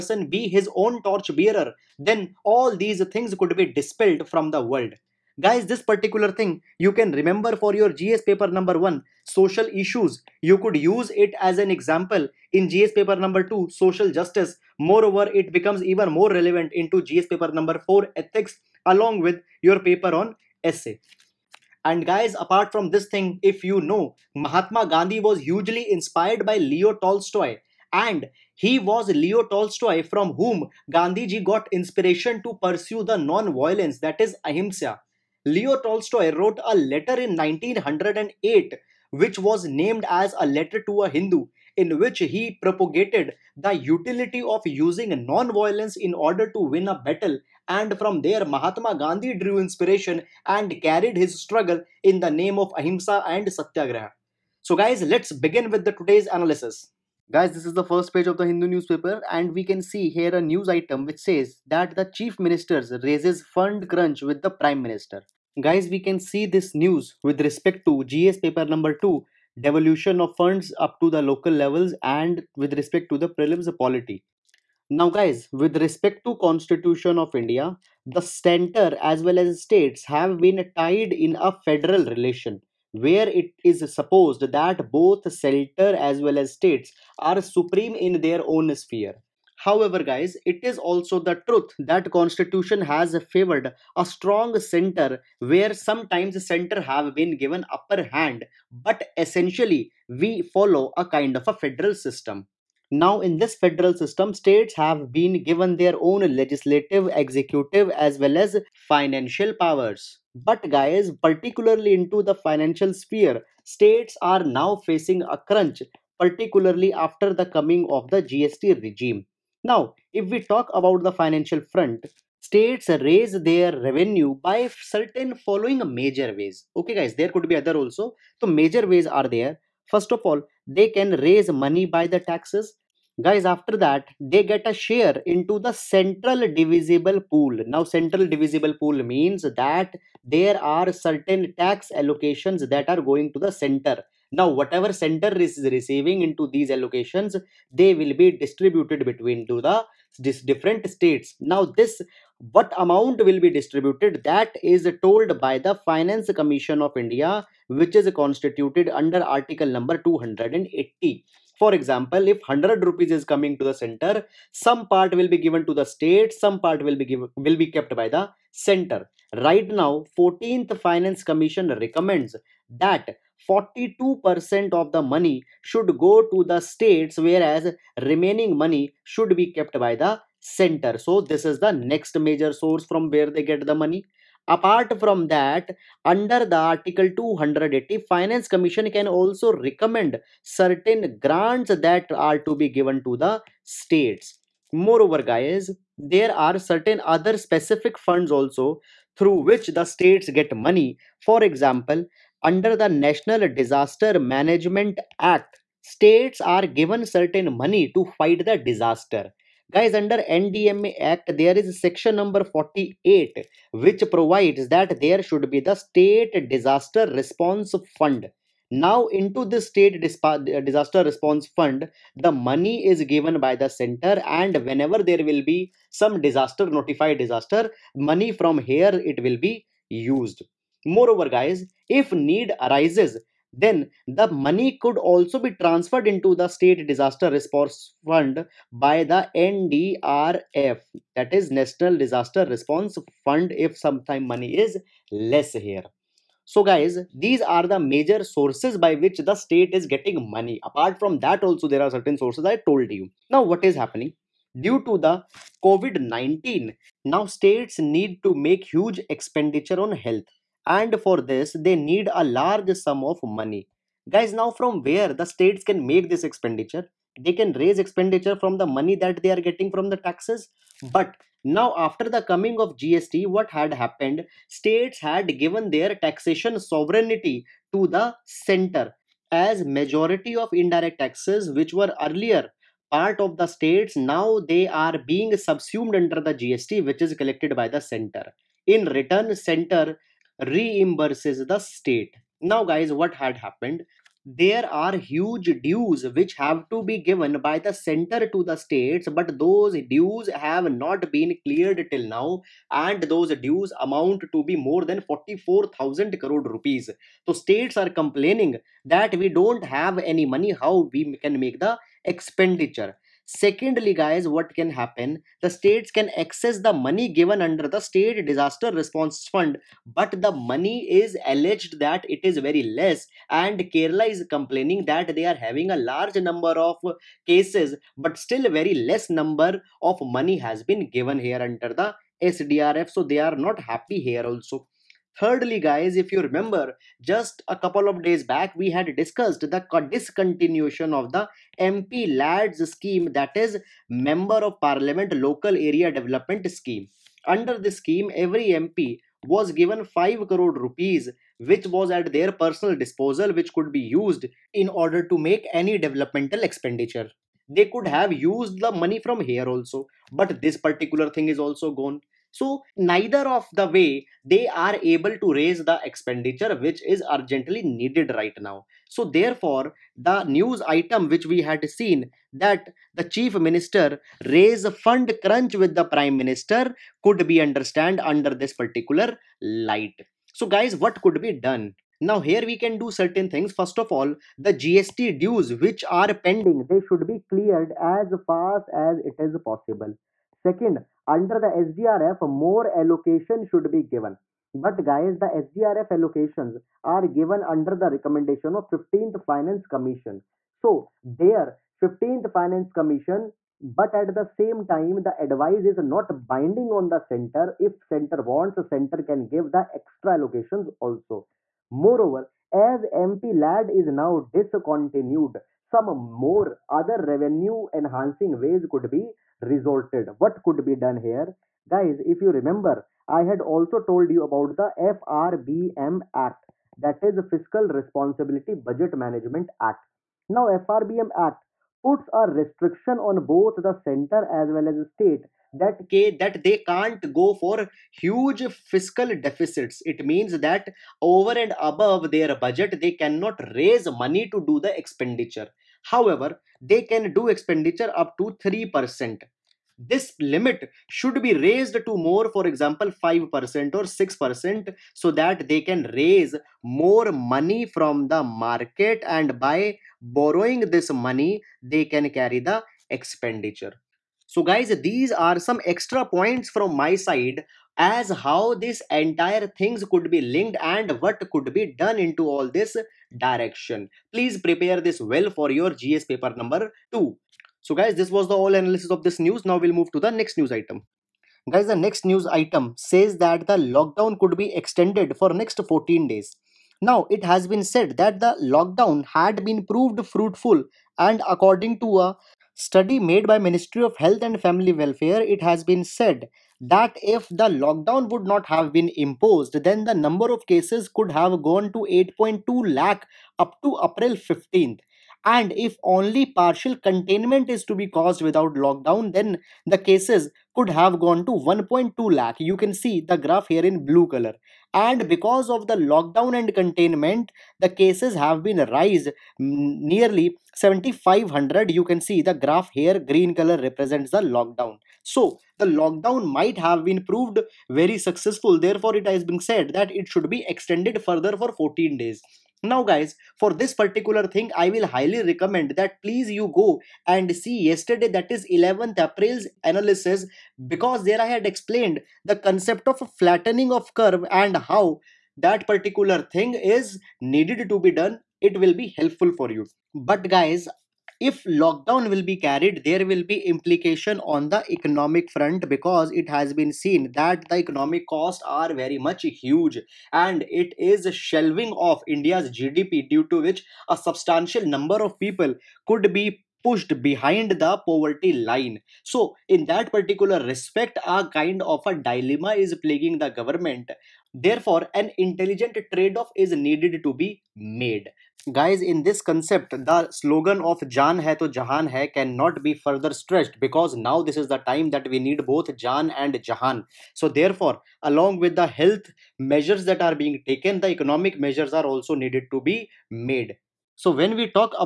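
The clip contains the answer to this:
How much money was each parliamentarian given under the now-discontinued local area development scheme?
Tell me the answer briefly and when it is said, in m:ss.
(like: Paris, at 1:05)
5 crore rupees, at 5:49.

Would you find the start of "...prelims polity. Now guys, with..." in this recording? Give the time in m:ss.
1:13.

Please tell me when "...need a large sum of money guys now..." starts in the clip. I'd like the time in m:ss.
4:21.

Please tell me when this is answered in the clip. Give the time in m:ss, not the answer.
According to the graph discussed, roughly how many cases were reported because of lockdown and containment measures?
8:39.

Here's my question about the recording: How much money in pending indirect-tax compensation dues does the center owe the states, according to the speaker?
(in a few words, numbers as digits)
More than 44,000 crore rupees.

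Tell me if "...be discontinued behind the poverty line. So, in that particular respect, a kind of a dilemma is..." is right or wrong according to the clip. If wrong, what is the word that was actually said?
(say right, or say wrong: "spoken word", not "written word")
wrong: "pushed", not "discontinued".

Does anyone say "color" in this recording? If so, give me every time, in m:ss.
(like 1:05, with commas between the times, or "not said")
8:34, 8:43.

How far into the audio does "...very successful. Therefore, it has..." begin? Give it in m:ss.
8:47.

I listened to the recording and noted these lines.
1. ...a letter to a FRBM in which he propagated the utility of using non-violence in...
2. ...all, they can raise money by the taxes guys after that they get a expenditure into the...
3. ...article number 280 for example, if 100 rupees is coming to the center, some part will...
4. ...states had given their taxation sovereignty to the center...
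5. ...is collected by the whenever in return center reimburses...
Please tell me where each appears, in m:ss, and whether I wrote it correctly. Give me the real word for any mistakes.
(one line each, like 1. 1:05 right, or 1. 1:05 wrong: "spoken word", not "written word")
1. 0:40 wrong: "Hindu", not "FRBM"
2. 2:10 wrong: "share", not "expenditure"
3. 2:39 right
4. 4:34 right
5. 4:47 wrong: "center", not "whenever".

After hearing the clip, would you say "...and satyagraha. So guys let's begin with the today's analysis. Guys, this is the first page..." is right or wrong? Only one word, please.
right.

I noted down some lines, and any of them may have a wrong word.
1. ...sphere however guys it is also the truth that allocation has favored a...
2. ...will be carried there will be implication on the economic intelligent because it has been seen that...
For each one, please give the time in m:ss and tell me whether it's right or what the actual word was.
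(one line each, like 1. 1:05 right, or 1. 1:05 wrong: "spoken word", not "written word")
1. 1:28 wrong: "constitution", not "allocation"
2. 9:12 wrong: "front", not "intelligent".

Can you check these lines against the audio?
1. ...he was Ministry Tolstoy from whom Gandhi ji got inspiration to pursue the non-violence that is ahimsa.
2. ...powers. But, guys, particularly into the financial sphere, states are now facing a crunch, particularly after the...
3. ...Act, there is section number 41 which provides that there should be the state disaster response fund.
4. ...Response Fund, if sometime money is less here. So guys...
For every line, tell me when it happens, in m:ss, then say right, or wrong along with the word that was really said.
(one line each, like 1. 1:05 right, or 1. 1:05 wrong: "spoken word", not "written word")
1. 0:28 wrong: "Leo", not "Ministry"
2. 1:49 right
3. 3:31 wrong: "48", not "41"
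4. 4:02 right.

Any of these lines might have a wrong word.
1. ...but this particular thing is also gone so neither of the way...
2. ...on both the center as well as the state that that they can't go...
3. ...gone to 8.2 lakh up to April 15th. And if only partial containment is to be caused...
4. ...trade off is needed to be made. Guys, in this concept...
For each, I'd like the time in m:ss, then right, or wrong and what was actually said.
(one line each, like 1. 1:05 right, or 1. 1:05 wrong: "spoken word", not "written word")
1. 6:00 right
2. 7:12 right
3. 8:21 right
4. 9:35 right.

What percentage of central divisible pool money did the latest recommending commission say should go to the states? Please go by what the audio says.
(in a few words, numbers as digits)
42%.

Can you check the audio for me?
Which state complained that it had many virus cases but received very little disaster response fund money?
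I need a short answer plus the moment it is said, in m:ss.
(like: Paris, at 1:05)
Kerala, at 5:23.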